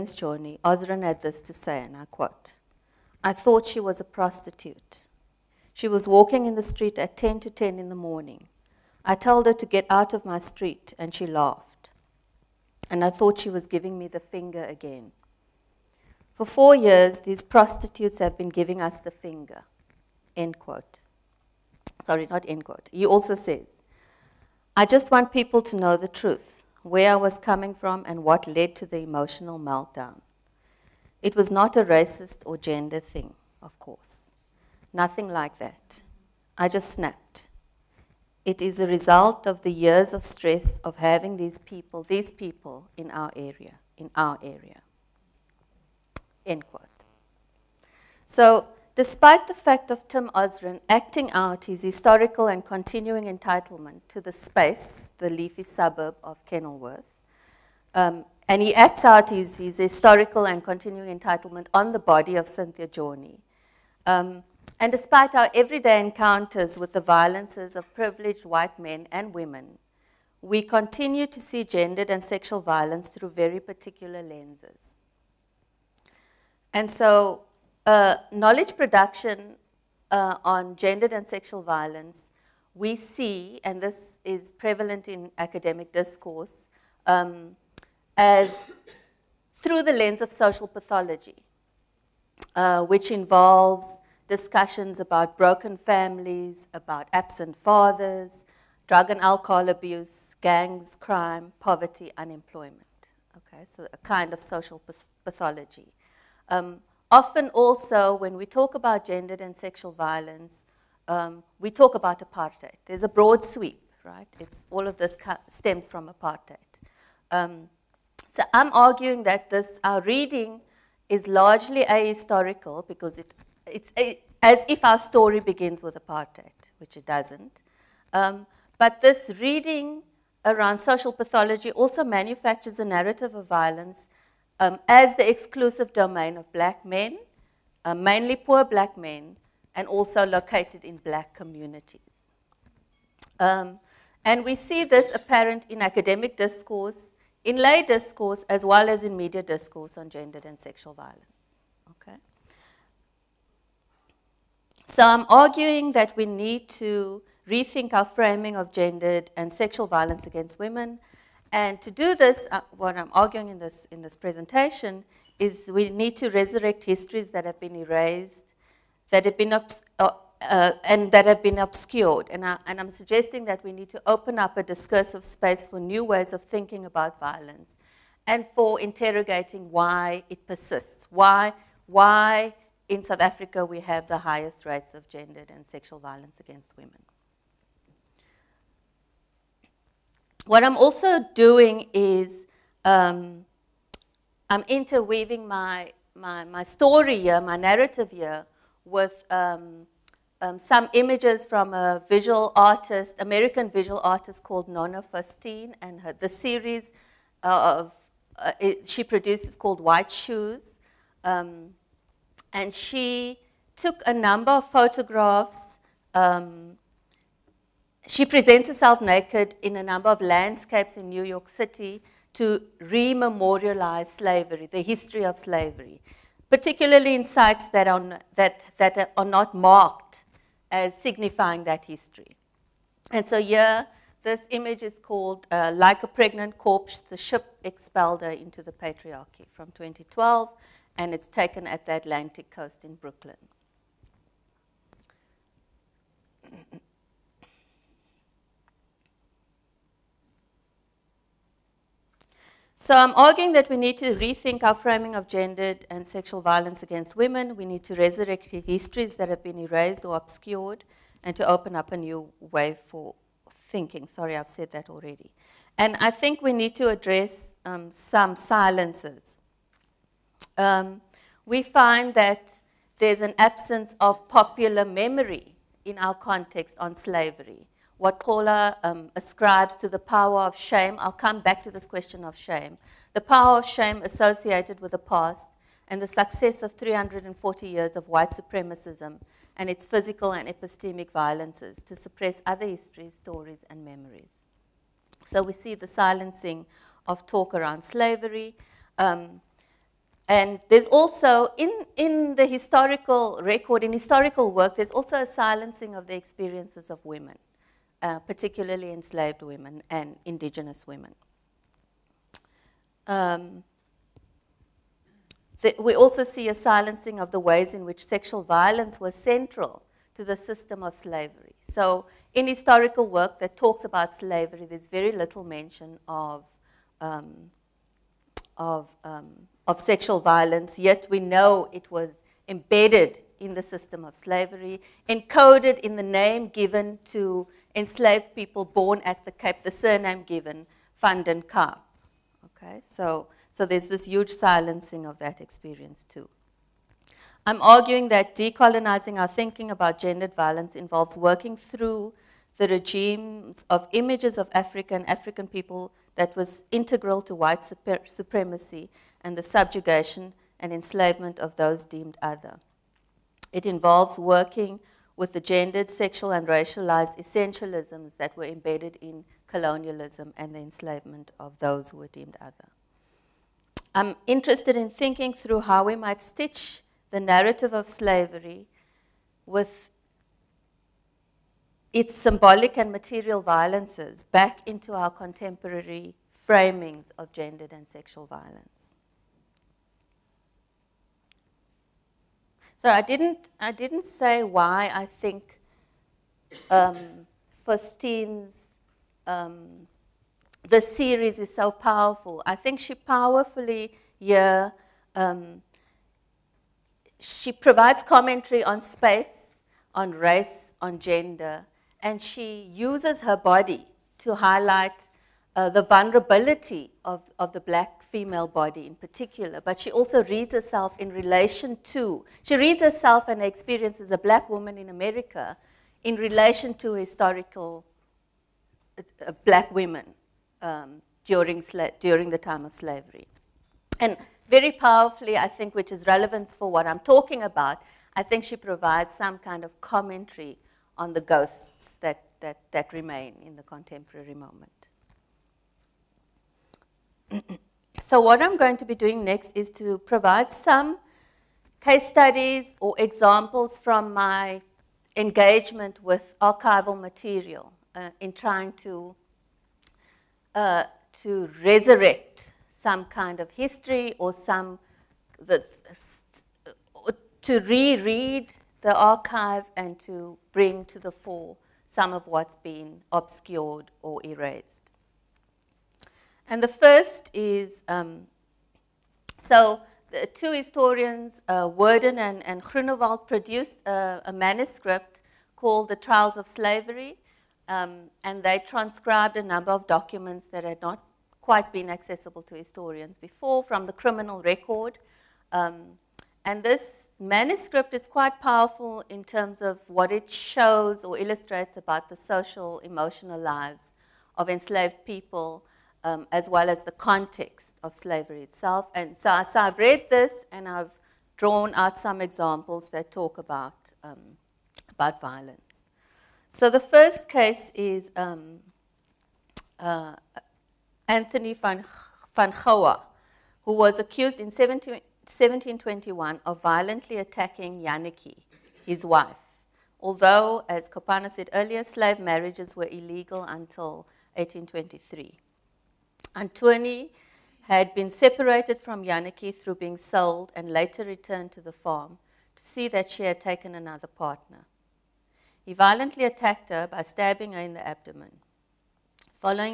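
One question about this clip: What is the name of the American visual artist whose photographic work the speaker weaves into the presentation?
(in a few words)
Nona Faustine.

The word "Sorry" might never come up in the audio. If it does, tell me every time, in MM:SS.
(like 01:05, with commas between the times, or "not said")
00:22, 04:24.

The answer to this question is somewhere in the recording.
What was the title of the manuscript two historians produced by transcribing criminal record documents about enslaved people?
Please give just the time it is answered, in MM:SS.
08:05.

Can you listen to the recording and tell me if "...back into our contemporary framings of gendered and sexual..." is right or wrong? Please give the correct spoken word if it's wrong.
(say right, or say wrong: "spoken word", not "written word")
right.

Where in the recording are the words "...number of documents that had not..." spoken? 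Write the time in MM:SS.
08:09.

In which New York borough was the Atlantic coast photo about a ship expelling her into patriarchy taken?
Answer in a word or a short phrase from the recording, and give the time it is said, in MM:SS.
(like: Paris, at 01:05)
Brooklyn, at 04:02.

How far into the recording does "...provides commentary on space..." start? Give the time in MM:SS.
06:47.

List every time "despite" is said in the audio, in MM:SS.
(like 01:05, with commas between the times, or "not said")
00:48, 01:04.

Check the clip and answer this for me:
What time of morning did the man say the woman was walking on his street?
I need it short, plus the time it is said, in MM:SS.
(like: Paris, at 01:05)
9:50, at 00:07.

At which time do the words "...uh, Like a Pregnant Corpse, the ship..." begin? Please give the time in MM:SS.
03:55.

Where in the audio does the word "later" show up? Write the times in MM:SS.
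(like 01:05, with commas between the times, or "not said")
09:00.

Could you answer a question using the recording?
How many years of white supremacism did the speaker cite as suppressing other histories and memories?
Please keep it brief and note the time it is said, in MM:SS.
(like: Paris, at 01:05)
340, at 04:46.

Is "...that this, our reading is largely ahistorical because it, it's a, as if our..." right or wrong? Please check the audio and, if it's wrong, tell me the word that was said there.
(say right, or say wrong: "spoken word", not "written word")
right.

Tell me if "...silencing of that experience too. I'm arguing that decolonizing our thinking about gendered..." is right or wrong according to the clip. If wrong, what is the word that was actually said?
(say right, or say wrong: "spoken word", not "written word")
right.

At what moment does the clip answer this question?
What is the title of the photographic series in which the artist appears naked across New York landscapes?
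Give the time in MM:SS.
03:29.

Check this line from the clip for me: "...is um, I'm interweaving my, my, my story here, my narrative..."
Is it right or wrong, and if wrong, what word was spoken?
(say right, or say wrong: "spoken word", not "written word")
right.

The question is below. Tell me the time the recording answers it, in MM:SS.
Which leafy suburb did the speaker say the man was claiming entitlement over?
00:56.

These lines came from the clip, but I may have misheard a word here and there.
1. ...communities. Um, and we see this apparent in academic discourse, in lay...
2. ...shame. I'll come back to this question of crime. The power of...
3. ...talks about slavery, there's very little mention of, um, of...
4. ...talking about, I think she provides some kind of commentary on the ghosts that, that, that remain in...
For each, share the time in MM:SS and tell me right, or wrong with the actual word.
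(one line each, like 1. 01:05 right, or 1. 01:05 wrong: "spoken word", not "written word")
1. 02:21 right
2. 04:40 wrong: "shame", not "crime"
3. 05:23 right
4. 07:17 right.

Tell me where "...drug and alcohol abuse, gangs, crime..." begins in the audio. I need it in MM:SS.
01:38.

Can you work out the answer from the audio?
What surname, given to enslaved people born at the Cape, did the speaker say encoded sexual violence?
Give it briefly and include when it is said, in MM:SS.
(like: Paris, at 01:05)
Van den Kaap, at 05:41.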